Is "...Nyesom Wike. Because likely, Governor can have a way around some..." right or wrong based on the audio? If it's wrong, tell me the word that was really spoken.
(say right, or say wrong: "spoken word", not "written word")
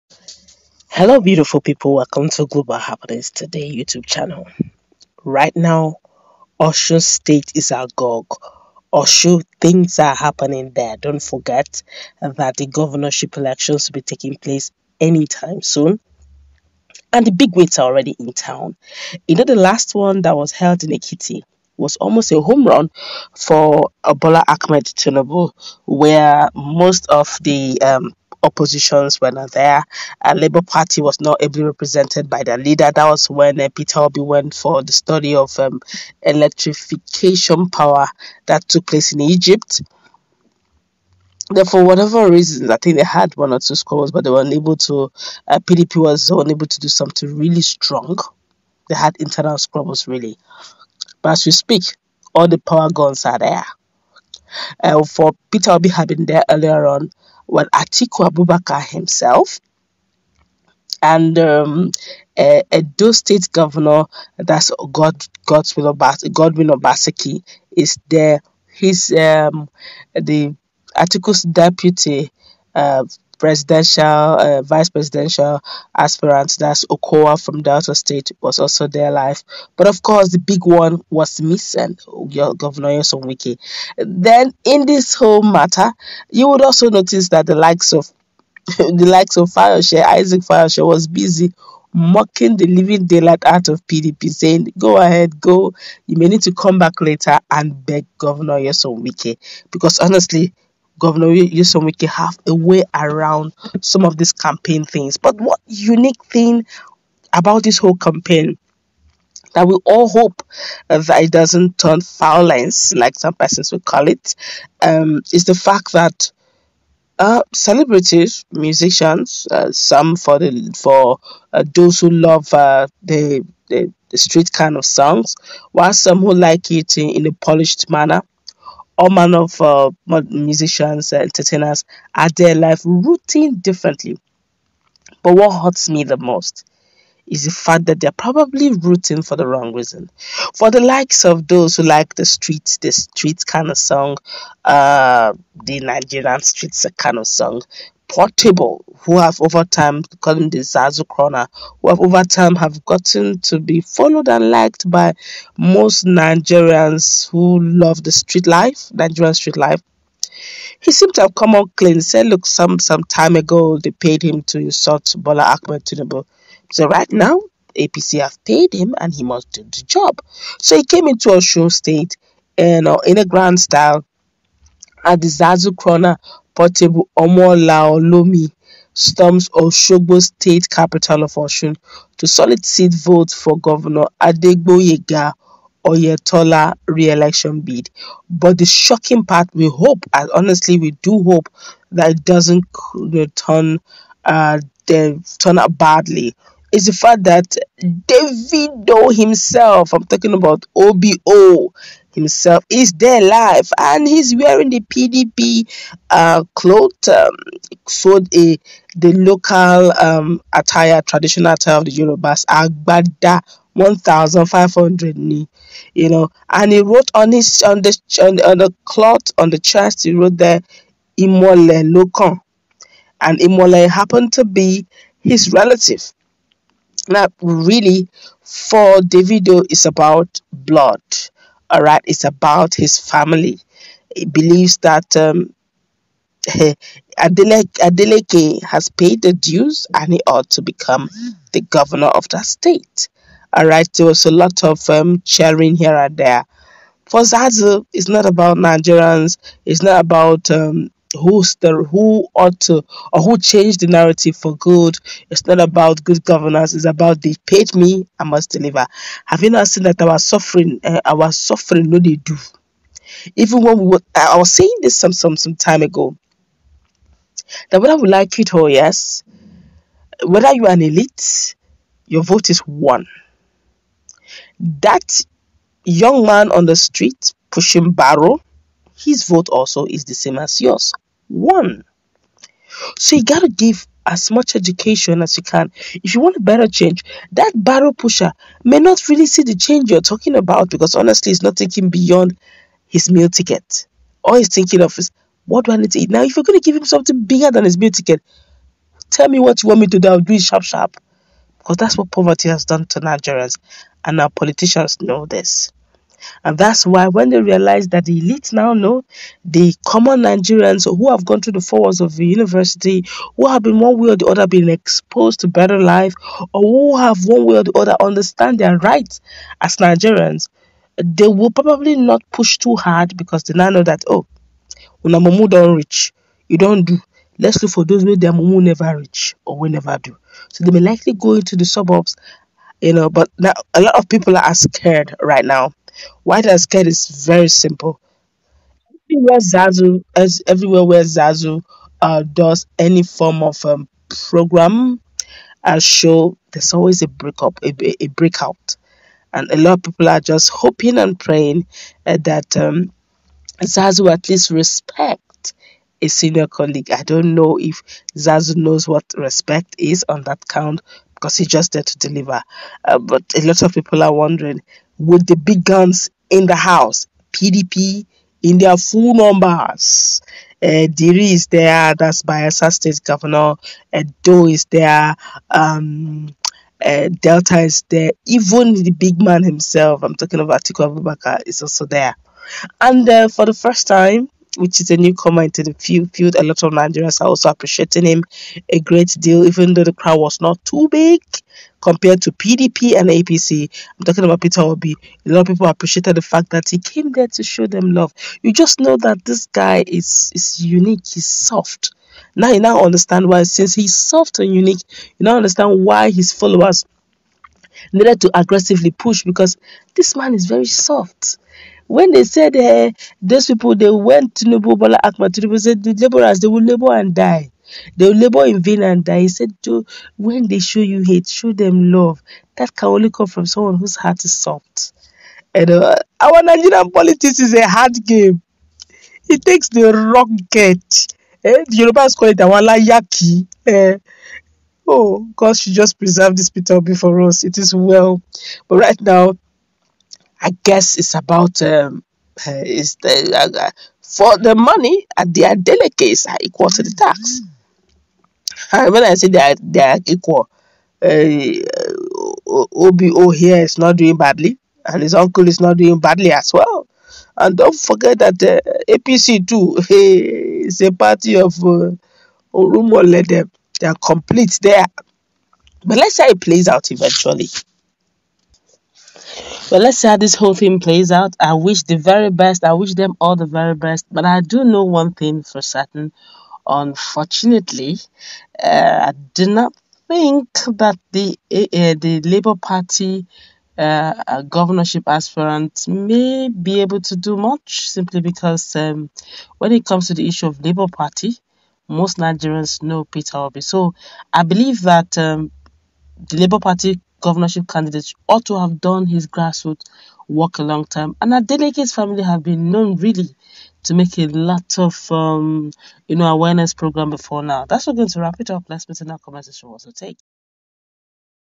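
wrong: "honestly", not "likely".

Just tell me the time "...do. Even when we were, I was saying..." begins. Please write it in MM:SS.
04:22.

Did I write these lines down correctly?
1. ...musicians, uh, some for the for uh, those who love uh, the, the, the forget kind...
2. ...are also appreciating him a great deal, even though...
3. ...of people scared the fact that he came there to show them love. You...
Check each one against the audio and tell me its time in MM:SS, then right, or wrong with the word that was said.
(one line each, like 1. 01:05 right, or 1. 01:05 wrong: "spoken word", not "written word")
1. 01:58 wrong: "street", not "forget"
2. 06:27 right
3. 06:35 wrong: "appreciated", not "scared".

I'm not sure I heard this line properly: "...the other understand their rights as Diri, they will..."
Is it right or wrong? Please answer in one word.
wrong.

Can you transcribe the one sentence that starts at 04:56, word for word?
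Now, if you're going to give him something bigger than his meal ticket, tell me what you want me to do.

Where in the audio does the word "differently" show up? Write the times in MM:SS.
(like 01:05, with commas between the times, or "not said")
02:13.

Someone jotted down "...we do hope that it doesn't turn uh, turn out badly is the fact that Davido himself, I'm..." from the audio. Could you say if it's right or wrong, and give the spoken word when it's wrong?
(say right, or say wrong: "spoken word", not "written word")
right.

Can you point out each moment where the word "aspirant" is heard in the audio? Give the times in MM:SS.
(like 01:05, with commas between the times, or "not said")
01:15, 08:05.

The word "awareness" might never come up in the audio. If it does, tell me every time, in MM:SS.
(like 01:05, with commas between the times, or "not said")
08:26.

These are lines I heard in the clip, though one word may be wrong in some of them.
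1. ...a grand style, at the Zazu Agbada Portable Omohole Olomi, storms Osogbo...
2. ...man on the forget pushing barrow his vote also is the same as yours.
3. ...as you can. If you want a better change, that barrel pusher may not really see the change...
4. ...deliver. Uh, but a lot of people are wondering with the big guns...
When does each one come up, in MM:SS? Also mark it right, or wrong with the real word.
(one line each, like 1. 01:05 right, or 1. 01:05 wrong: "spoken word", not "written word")
1. 02:53 wrong: "Crooner", not "Agbada"
2. 04:36 wrong: "street", not "forget"
3. 04:45 right
4. 06:01 right.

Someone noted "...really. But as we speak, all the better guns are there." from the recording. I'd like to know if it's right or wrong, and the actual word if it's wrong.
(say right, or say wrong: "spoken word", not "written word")
wrong: "power", not "better".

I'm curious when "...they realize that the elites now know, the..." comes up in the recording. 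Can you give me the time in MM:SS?
05:07.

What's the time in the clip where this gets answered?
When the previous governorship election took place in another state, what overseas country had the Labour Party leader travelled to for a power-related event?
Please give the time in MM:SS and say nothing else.
00:39.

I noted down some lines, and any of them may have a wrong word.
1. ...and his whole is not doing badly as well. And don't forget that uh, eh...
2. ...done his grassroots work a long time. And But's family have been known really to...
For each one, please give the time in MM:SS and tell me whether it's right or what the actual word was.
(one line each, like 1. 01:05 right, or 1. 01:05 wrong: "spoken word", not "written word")
1. 07:34 wrong: "uncle", not "whole"
2. 08:18 wrong: "Adeleke", not "But".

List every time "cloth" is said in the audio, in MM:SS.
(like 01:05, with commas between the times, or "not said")
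03:26, 03:38.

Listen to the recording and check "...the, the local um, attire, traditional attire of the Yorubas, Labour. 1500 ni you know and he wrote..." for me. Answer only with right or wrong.
wrong.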